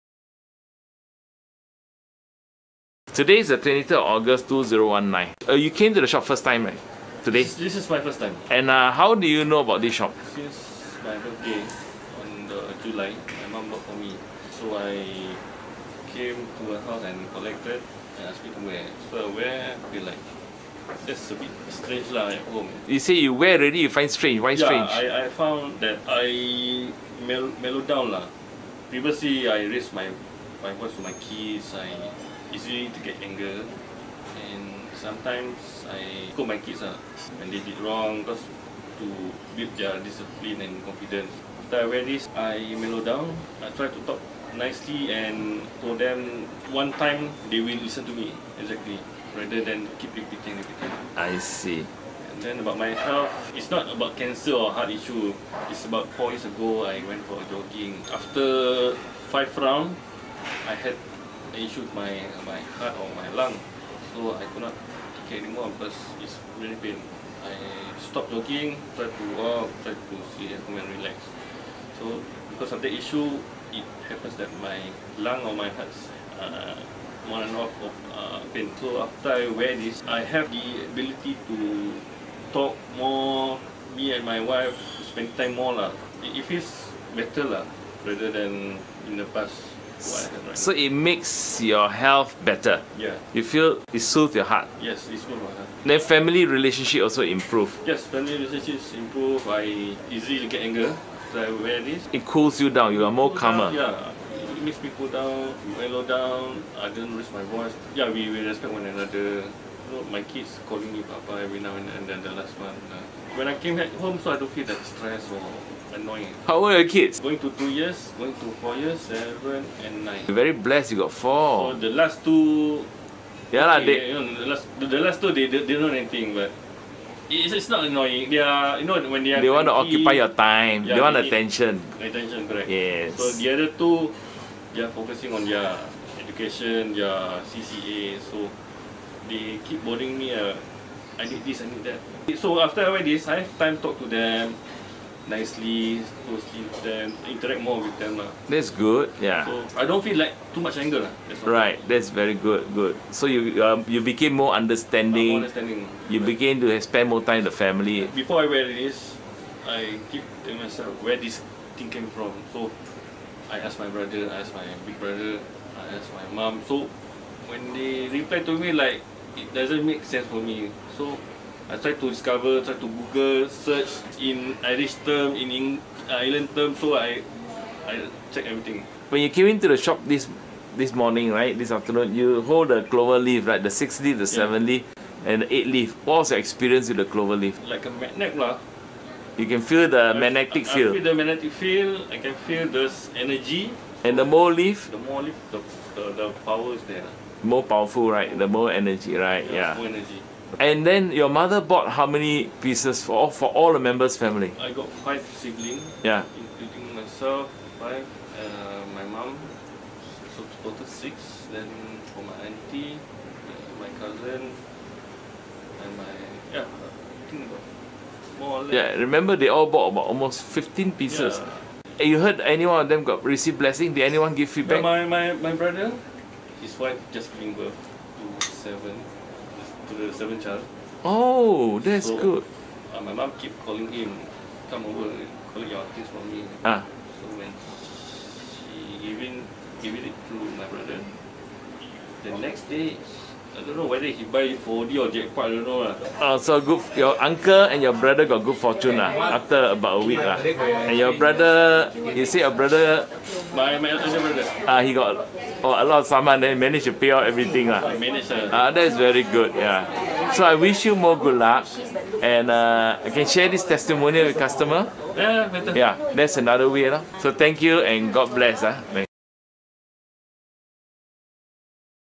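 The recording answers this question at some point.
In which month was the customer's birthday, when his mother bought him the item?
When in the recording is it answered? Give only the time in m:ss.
0:12.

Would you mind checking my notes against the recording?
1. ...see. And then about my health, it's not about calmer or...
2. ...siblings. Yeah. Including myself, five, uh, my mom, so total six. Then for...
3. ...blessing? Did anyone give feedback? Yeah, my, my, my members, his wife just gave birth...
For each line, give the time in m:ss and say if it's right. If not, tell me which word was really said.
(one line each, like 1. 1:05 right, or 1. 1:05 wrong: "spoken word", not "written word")
1. 0:51 wrong: "cancer", not "calmer"
2. 3:25 right
3. 3:43 wrong: "brother", not "members".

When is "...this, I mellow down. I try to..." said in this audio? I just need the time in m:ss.
0:42.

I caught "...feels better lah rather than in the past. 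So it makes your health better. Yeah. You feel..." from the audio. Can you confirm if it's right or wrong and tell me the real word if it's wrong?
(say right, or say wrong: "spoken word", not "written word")
right.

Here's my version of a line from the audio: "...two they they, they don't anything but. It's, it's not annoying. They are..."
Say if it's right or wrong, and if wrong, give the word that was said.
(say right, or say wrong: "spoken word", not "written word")
right.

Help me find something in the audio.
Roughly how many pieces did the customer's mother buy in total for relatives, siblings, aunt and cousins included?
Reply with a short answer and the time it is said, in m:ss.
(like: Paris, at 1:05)
15, at 3:40.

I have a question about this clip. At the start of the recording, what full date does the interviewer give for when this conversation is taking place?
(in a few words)
23 August 2019.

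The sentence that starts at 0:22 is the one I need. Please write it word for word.
You say you wear already, you find strange.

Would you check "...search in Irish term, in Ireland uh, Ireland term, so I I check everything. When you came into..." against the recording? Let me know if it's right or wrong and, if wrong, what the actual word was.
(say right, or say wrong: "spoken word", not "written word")
wrong: "Eng", not "Ireland".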